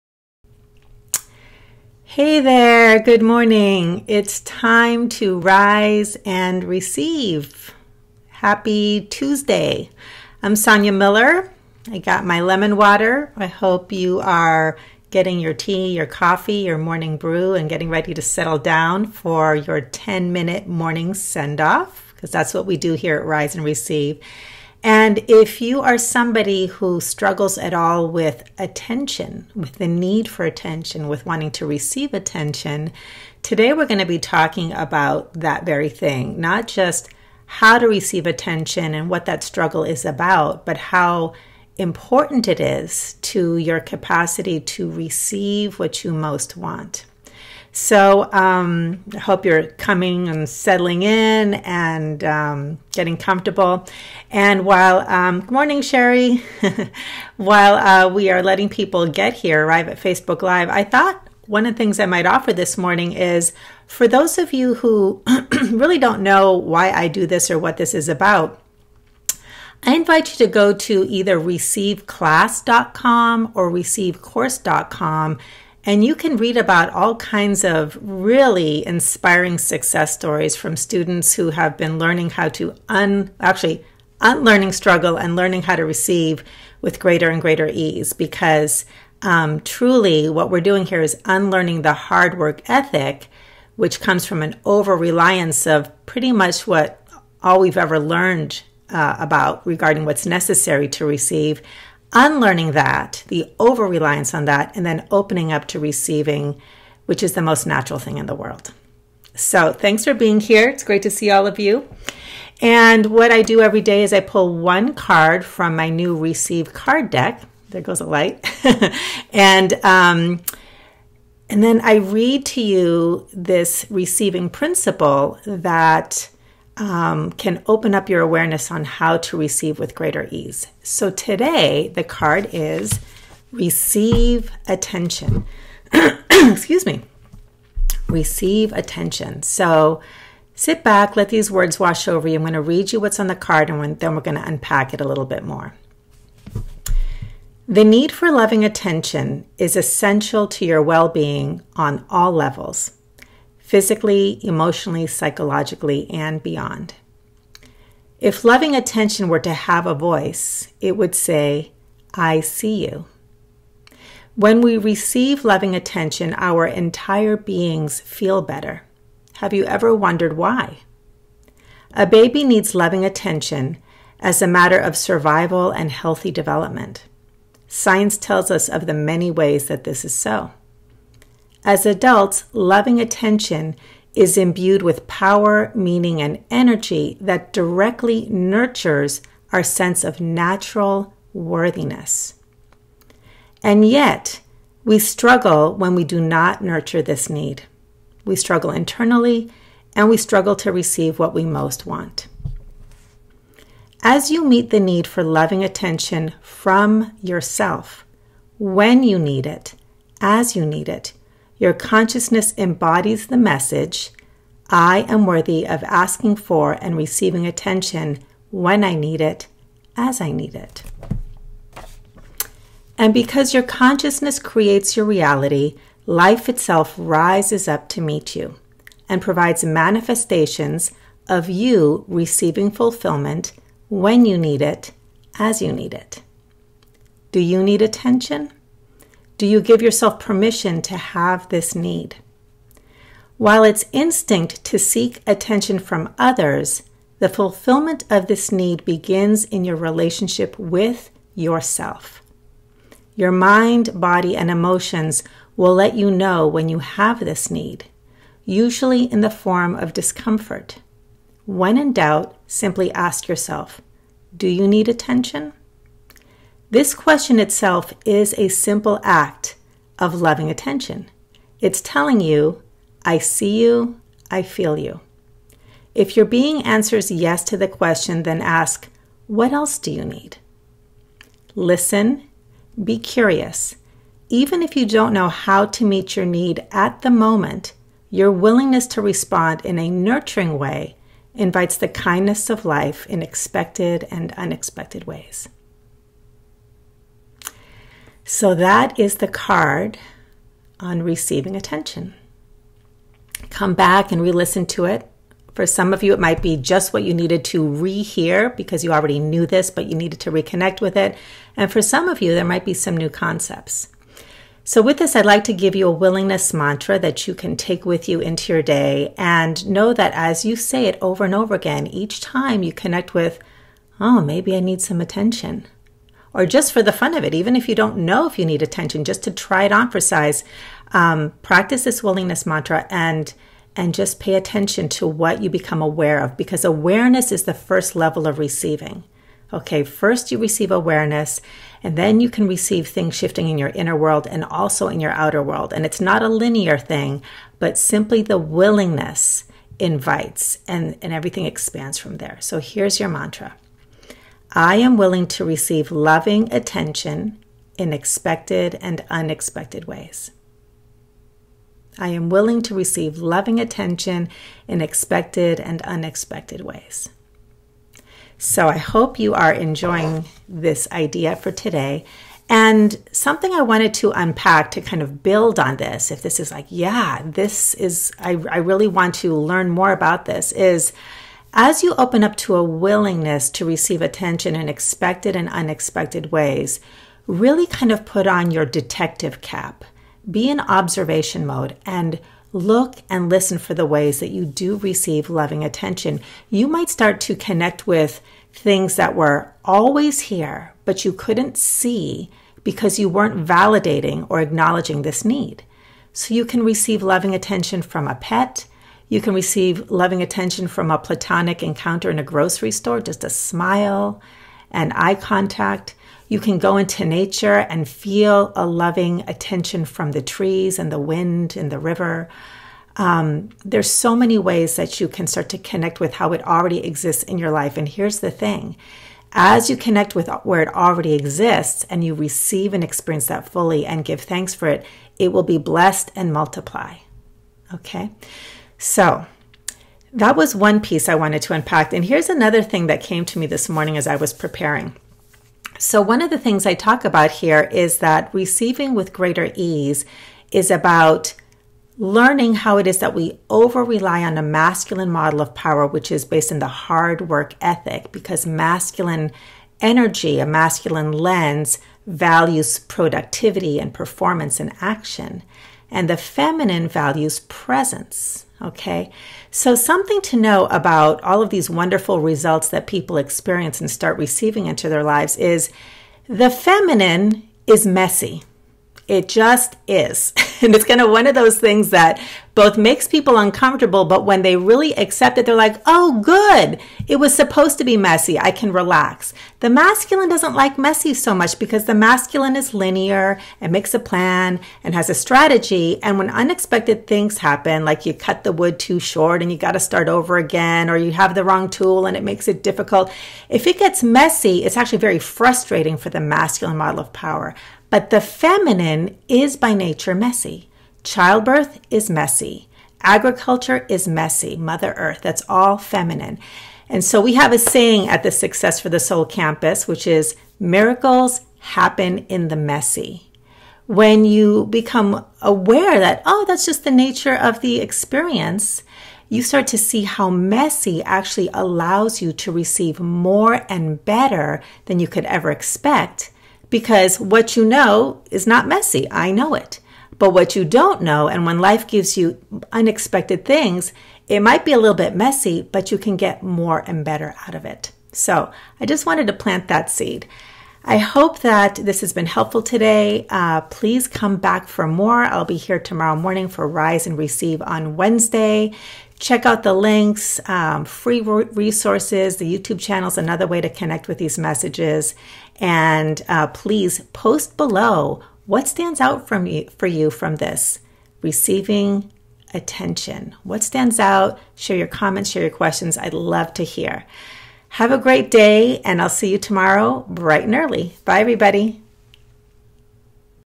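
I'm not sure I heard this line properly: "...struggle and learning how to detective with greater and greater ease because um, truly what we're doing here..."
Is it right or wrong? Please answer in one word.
wrong.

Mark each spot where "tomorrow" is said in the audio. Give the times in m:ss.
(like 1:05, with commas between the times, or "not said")
9:15, 9:39.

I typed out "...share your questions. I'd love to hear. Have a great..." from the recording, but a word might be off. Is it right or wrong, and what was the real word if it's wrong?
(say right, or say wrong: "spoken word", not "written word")
right.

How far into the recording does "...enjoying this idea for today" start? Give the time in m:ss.
6:09.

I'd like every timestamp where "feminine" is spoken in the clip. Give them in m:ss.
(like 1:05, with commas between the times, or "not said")
7:46, 7:56, 8:28, 8:35.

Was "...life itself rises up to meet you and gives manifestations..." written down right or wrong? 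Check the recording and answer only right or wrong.
wrong.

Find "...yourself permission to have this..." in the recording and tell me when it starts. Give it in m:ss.
3:59.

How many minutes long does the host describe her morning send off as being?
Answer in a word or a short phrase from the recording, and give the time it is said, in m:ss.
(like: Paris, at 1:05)
10, at 0:19.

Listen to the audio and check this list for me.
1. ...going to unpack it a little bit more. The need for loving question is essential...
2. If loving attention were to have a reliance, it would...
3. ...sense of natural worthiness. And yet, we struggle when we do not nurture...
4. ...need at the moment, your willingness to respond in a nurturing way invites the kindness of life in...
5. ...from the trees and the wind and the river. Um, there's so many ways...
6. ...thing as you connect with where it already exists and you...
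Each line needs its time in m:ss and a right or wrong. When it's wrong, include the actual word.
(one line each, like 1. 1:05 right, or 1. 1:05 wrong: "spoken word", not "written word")
1. 2:24 wrong: "attention", not "question"
2. 2:38 wrong: "voice", not "reliance"
3. 3:09 right
4. 4:46 right
5. 6:59 right
6. 7:08 right.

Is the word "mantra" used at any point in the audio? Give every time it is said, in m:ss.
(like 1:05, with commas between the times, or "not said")
5:16, 5:32, 5:53.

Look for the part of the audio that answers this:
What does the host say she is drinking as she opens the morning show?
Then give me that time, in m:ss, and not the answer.
0:12.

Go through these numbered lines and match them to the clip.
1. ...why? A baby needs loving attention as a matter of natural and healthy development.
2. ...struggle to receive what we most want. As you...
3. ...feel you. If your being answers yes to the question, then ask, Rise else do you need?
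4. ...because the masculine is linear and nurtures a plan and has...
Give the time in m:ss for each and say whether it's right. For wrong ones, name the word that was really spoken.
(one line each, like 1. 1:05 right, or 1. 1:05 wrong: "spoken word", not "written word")
1. 2:50 wrong: "survival", not "natural"
2. 3:20 right
3. 4:34 wrong: "What", not "Rise"
4. 8:11 wrong: "makes", not "nurtures".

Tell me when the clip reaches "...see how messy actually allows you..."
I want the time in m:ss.
8:49.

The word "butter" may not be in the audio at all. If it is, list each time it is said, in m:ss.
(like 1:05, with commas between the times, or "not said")
not said.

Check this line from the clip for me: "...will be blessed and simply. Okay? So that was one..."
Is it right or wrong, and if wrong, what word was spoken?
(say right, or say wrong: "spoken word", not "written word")
wrong: "multiply", not "simply".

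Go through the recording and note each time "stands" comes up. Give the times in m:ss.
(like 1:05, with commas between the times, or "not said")
9:28, 9:33.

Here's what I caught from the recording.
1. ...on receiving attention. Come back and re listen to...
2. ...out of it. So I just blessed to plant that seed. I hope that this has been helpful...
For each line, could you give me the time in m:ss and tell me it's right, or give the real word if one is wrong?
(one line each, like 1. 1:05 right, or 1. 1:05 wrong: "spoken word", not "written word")
1. 5:00 right
2. 9:07 wrong: "wanted", not "blessed".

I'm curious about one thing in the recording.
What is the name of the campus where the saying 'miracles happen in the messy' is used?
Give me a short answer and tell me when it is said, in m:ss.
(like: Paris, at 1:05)
Success for the Soul, at 8:38.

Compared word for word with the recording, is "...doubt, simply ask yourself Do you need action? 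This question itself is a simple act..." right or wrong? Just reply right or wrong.
wrong.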